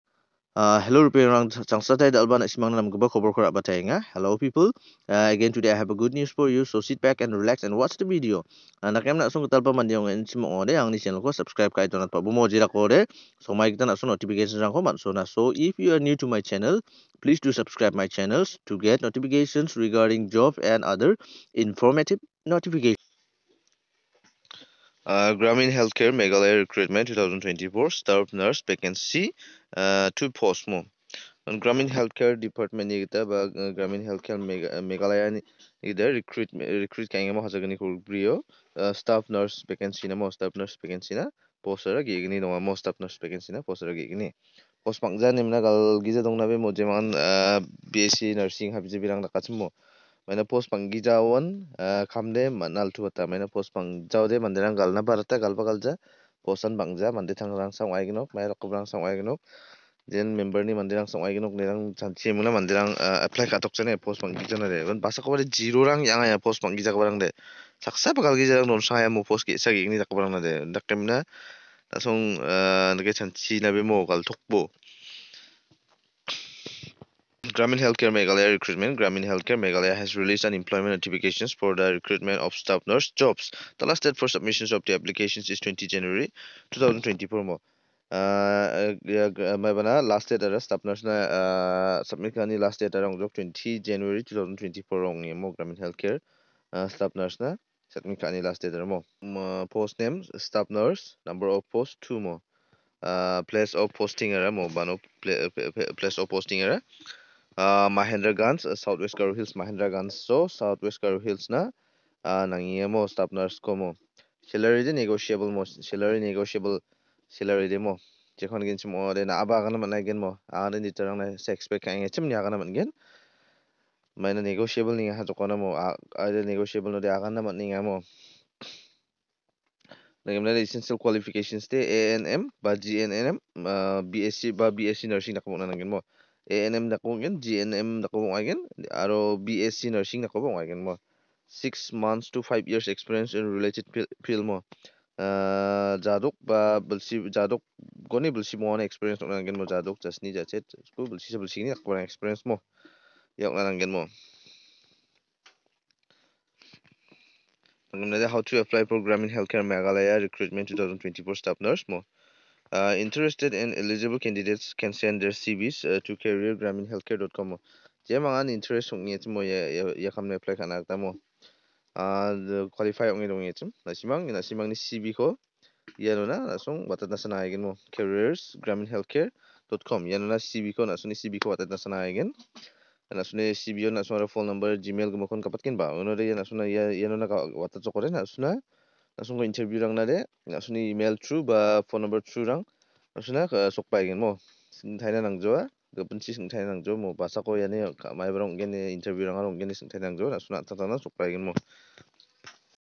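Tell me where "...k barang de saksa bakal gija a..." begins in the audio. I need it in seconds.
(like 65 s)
66 s.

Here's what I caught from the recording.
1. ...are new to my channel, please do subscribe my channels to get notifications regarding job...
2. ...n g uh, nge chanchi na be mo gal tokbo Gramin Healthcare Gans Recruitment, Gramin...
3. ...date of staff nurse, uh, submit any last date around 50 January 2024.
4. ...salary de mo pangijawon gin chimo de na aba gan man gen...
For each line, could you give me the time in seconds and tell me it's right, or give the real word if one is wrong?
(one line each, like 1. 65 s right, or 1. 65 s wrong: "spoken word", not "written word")
1. 15 s right
2. 72 s wrong: "Meghalaya", not "Gans"
3. 90 s wrong: "20", not "50"
4. 117 s wrong: "jekhon", not "pangijawon".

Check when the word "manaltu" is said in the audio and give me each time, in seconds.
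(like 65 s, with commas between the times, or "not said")
52 s.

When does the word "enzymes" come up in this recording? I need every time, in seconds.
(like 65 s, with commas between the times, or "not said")
not said.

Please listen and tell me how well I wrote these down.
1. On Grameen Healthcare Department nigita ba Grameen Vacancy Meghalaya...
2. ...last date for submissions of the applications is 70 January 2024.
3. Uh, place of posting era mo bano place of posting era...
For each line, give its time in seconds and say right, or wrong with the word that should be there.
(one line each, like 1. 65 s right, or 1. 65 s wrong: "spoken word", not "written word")
1. 31 s wrong: "Healthcare", not "Vacancy"
2. 83 s wrong: "20", not "70"
3. 103 s right.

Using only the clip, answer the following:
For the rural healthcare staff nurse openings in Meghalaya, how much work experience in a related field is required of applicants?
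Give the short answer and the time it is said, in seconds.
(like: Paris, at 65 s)
6 months to 5 years, at 141 s.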